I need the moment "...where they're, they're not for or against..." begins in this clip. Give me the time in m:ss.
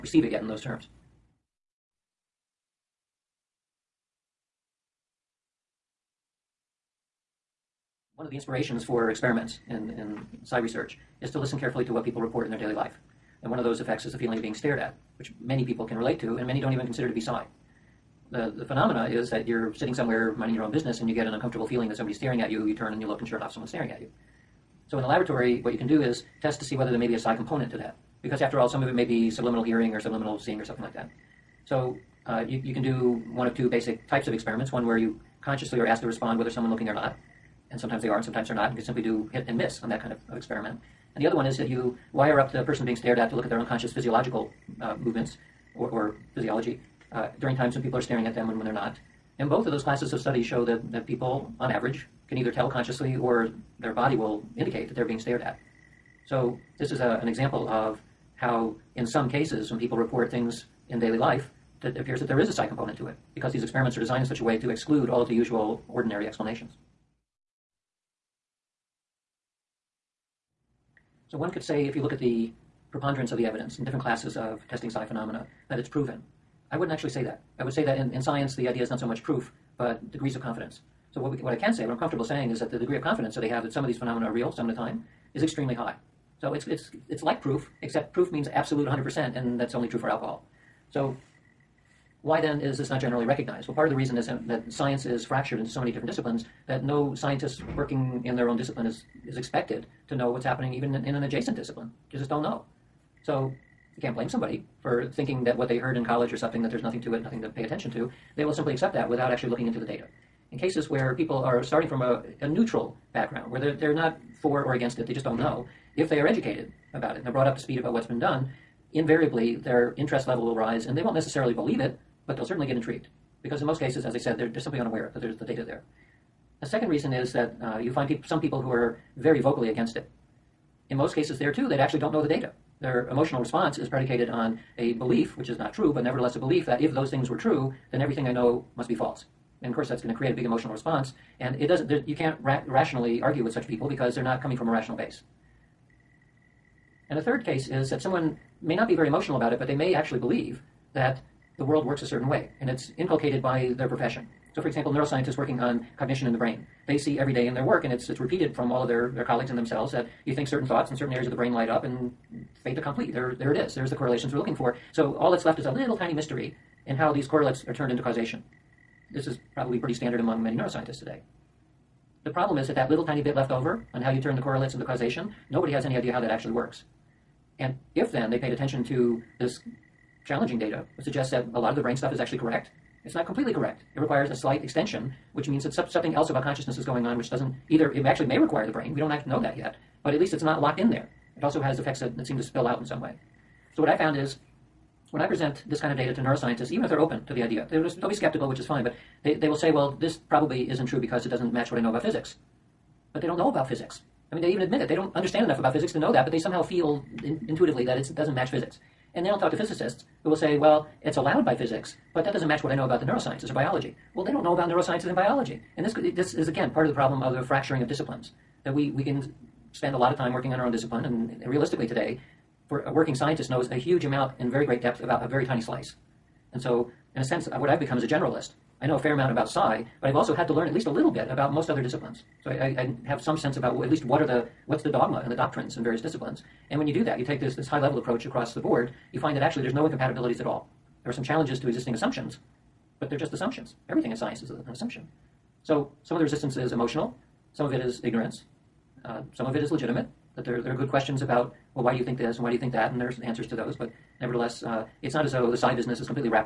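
1:53.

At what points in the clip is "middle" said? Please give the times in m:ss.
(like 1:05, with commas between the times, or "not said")
not said.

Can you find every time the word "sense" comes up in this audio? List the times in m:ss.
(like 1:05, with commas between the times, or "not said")
3:47, 3:53.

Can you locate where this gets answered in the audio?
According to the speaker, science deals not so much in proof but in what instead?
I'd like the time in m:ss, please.
1:20.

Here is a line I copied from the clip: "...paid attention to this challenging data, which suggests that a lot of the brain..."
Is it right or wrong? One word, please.
right.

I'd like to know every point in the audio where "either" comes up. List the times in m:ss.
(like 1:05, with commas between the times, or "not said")
0:52, 3:07.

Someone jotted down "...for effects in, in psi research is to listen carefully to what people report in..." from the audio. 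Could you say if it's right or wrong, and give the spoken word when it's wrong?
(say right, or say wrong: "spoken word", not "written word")
wrong: "experiments", not "effects".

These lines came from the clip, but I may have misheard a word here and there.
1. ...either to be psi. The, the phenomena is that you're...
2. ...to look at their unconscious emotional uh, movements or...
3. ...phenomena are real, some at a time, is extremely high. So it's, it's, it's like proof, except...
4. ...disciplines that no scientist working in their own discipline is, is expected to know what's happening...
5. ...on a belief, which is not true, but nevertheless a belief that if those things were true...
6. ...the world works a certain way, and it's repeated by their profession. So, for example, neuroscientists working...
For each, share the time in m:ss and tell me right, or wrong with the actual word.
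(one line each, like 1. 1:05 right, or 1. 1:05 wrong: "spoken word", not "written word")
1. 0:16 wrong: "consider", not "either"
2. 0:43 wrong: "physiological", not "emotional"
3. 1:23 right
4. 1:36 right
5. 2:14 right
6. 2:31 wrong: "inculcated", not "repeated".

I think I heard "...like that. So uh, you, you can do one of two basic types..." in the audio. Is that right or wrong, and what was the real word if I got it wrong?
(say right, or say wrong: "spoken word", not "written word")
right.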